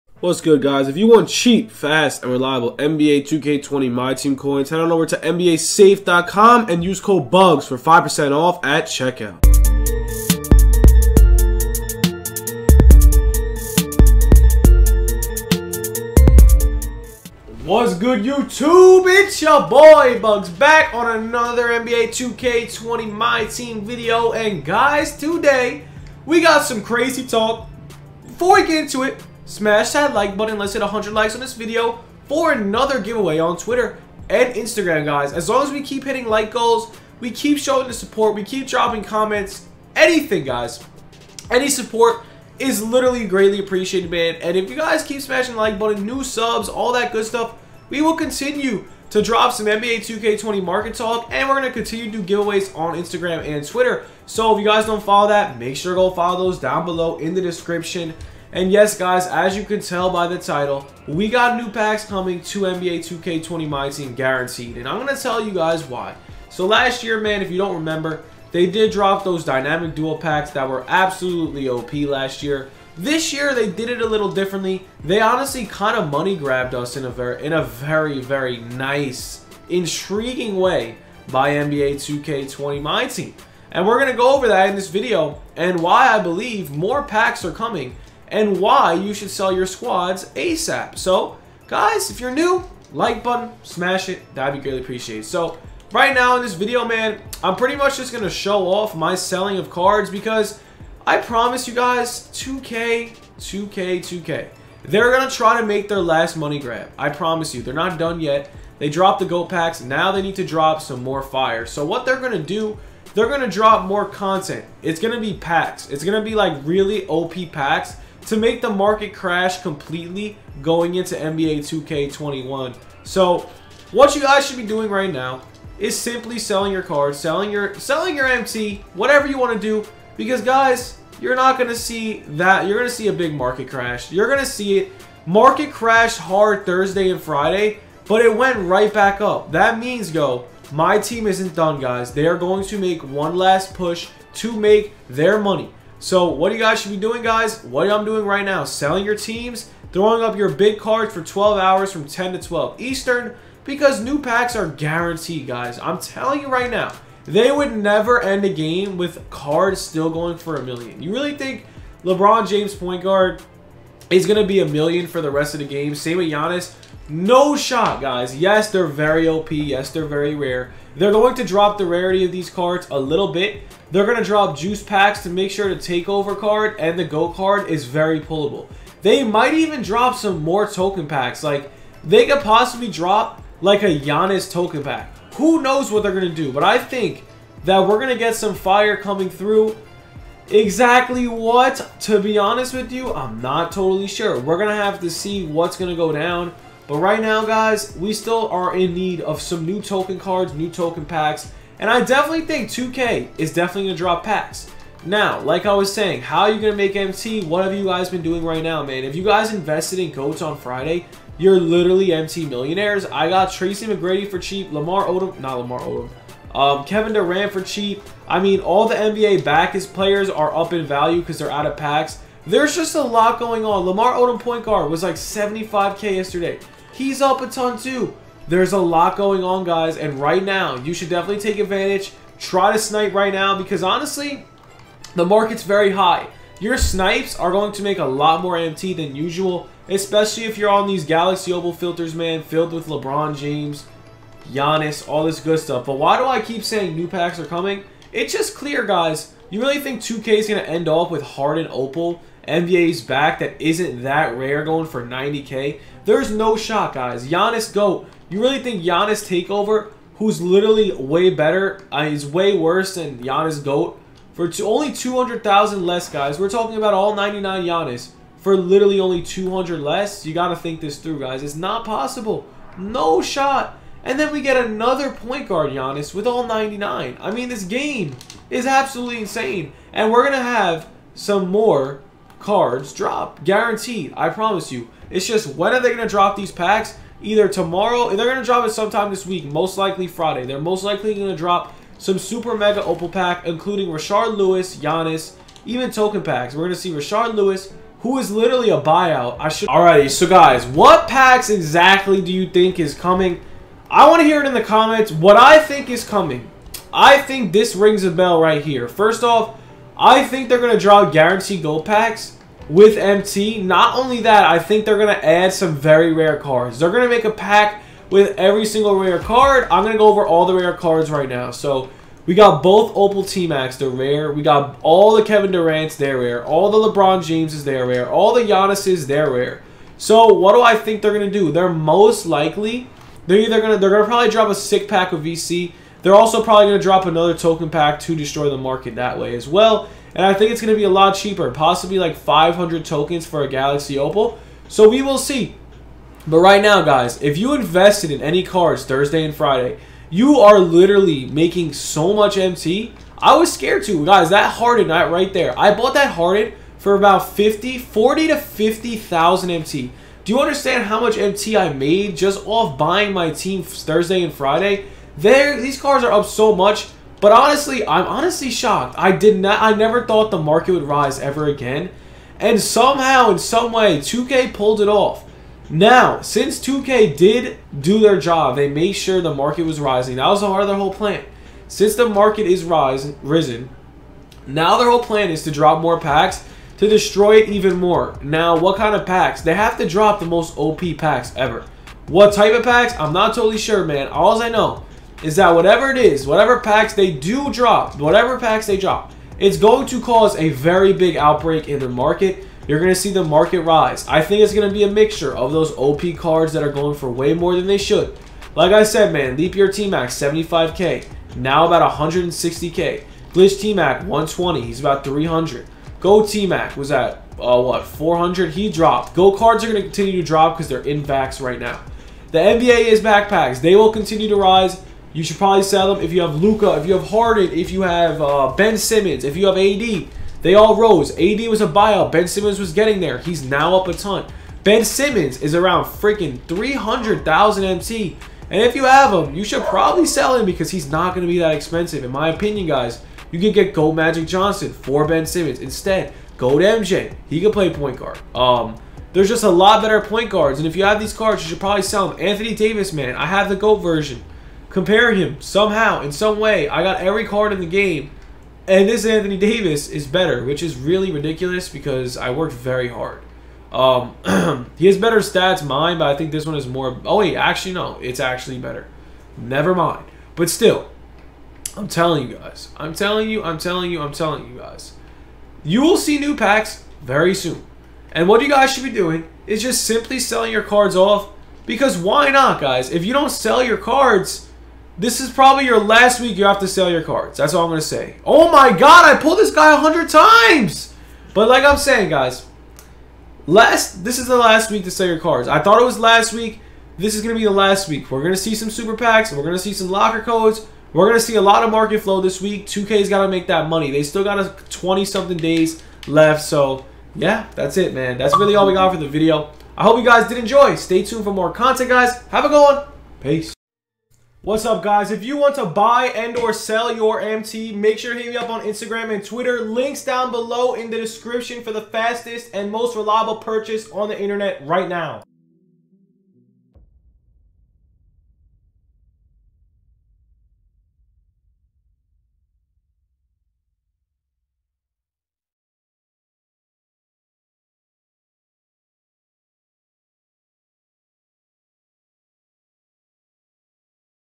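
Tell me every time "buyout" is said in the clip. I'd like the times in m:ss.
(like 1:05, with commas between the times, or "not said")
4:58, 7:11.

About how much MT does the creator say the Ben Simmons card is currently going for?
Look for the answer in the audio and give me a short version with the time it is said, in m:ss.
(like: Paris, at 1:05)
300,000 MT, at 7:16.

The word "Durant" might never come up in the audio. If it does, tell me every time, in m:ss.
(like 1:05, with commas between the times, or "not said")
3:37, 5:25.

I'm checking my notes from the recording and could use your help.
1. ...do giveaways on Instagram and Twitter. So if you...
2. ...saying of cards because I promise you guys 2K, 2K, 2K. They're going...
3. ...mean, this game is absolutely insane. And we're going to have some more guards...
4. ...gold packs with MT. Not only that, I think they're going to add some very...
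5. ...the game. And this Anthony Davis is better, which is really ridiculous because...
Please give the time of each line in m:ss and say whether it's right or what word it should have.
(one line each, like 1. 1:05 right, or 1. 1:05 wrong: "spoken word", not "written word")
1. 0:52 right
2. 1:39 wrong: "selling", not "saying"
3. 4:37 wrong: "cards", not "guards"
4. 5:11 right
5. 7:37 right.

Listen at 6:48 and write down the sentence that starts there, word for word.
Like I said, man, Leap Year T-Mac 75k.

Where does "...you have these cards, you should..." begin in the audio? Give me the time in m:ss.
7:30.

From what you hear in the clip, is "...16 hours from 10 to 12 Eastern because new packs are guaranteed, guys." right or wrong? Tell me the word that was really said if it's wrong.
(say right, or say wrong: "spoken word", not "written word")
wrong: "12", not "16".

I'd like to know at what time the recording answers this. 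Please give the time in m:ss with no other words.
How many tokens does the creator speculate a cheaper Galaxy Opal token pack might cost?
5:42.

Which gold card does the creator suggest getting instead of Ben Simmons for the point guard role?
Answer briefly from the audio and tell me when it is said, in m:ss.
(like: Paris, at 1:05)
Magic Johnson, at 7:23.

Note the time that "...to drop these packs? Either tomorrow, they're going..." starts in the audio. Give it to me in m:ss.
4:46.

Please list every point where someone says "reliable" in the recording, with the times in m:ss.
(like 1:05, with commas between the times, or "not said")
0:02, 8:42.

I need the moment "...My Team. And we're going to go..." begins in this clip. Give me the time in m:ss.
1:22.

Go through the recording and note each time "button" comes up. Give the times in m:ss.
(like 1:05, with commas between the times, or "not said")
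0:30, 0:45, 1:33.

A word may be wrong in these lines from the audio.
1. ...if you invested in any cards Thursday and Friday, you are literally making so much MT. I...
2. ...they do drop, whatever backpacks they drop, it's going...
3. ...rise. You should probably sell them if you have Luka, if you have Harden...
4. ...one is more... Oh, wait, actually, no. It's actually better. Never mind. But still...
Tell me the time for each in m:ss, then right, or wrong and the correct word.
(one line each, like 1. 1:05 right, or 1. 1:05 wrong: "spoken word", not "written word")
1. 5:47 right
2. 6:36 wrong: "packs", not "backpacks"
3. 7:04 right
4. 7:46 right.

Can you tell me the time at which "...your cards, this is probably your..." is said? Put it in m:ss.
8:03.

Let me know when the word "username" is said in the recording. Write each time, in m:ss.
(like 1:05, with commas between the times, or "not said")
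not said.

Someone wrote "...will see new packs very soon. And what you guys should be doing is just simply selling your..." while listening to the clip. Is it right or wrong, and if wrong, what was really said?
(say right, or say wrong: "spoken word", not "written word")
right.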